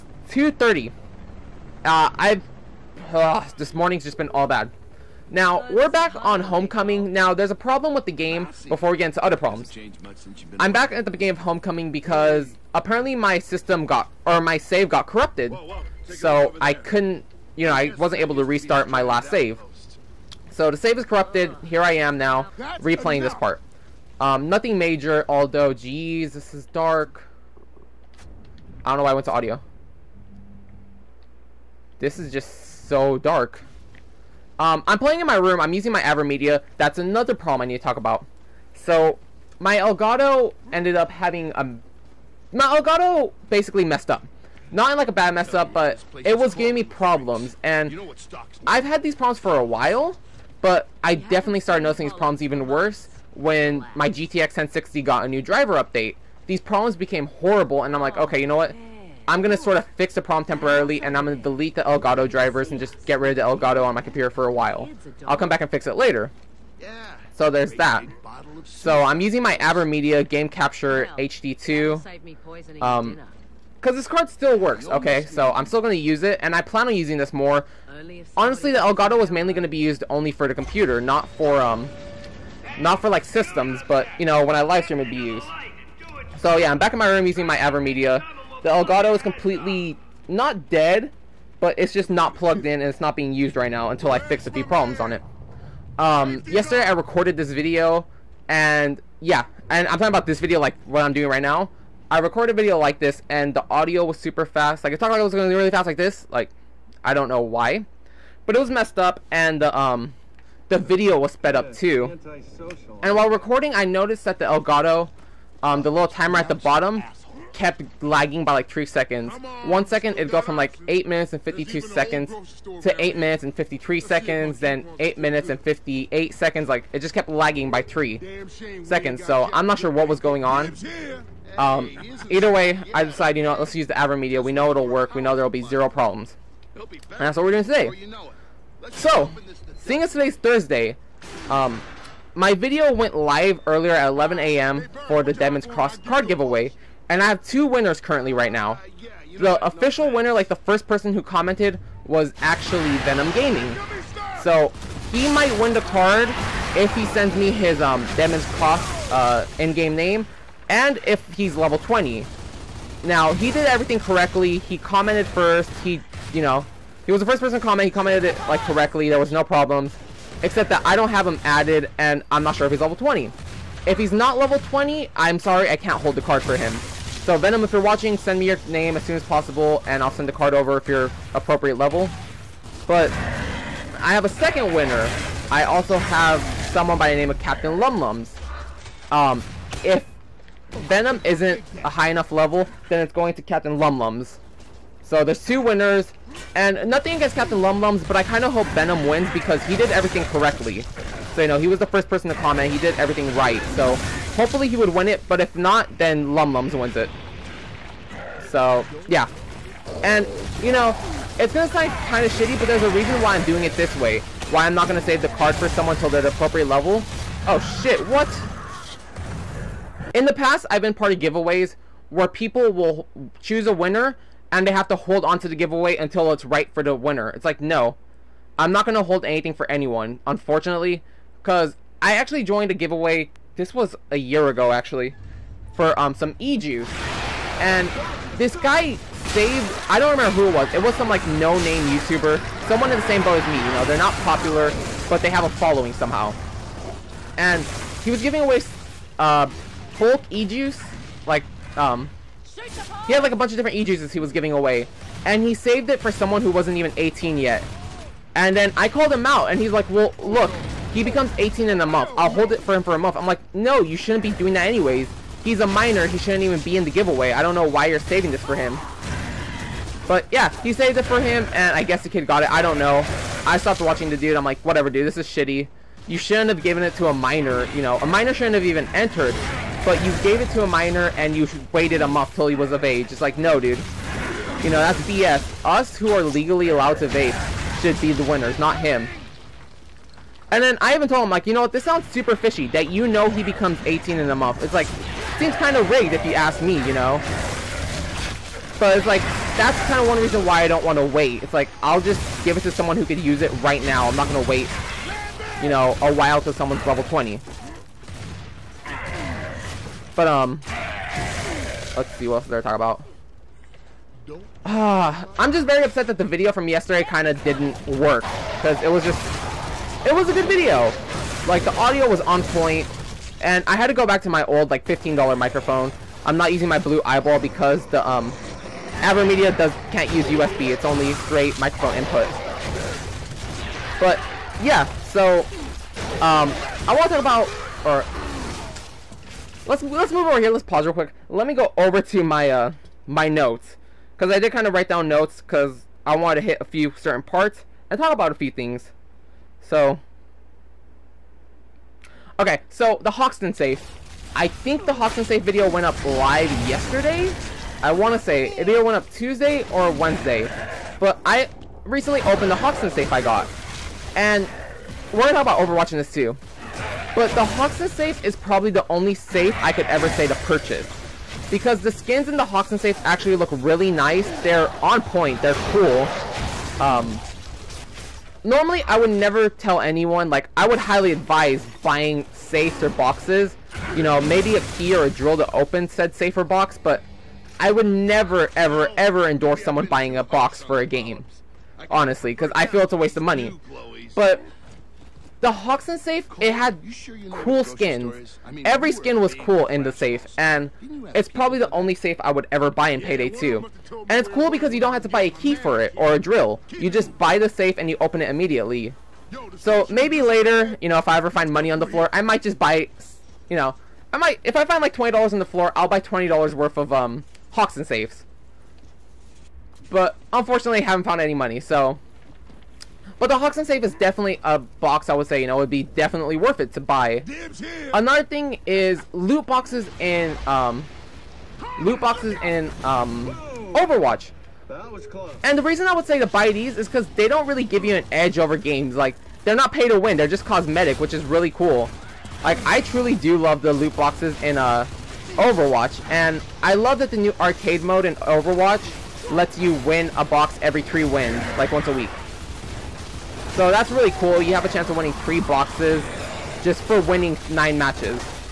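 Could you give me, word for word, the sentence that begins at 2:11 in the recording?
Um, either way, I decided, you know, let's use the Media.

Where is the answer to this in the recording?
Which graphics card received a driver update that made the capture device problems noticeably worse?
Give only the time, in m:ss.
0:54.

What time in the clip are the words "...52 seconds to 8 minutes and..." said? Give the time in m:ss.
2:01.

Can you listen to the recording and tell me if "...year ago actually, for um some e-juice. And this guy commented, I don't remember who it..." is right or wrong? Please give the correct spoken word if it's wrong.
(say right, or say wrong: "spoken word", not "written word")
wrong: "saved", not "commented".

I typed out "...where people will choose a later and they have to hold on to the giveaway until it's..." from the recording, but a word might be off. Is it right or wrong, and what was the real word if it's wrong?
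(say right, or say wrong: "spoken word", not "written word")
wrong: "winner", not "later".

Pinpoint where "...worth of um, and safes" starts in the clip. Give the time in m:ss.
6:56.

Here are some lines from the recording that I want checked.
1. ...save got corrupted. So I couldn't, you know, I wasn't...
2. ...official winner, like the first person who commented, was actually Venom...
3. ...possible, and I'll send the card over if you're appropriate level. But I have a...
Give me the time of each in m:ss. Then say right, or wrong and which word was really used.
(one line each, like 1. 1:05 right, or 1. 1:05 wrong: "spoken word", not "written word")
1. 0:14 right
2. 2:29 right
3. 2:59 right.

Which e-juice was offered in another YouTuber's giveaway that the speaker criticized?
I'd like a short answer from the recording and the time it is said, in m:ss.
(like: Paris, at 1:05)
Hulk, at 4:09.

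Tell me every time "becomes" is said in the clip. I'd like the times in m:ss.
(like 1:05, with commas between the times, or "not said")
4:21, 4:53.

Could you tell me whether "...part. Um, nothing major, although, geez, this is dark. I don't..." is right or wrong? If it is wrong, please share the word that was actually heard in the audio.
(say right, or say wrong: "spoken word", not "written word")
right.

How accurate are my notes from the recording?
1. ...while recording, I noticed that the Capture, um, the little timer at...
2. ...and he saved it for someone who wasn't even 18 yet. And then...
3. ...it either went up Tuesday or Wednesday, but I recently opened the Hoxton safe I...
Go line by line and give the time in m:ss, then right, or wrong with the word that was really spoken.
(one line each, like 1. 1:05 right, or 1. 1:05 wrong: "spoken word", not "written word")
1. 1:53 wrong: "Elgato", not "Capture"
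2. 4:15 right
3. 5:58 right.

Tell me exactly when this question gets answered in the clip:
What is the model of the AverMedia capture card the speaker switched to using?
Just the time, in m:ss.
1:10.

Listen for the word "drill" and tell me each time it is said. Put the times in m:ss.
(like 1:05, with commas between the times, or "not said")
6:25, 6:46.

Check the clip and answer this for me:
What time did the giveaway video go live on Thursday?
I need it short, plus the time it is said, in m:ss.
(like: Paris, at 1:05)
11 a.m., at 2:24.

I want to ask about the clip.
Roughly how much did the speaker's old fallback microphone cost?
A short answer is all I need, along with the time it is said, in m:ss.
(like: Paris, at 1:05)
$15, at 5:24.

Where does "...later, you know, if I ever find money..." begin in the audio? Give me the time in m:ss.
6:50.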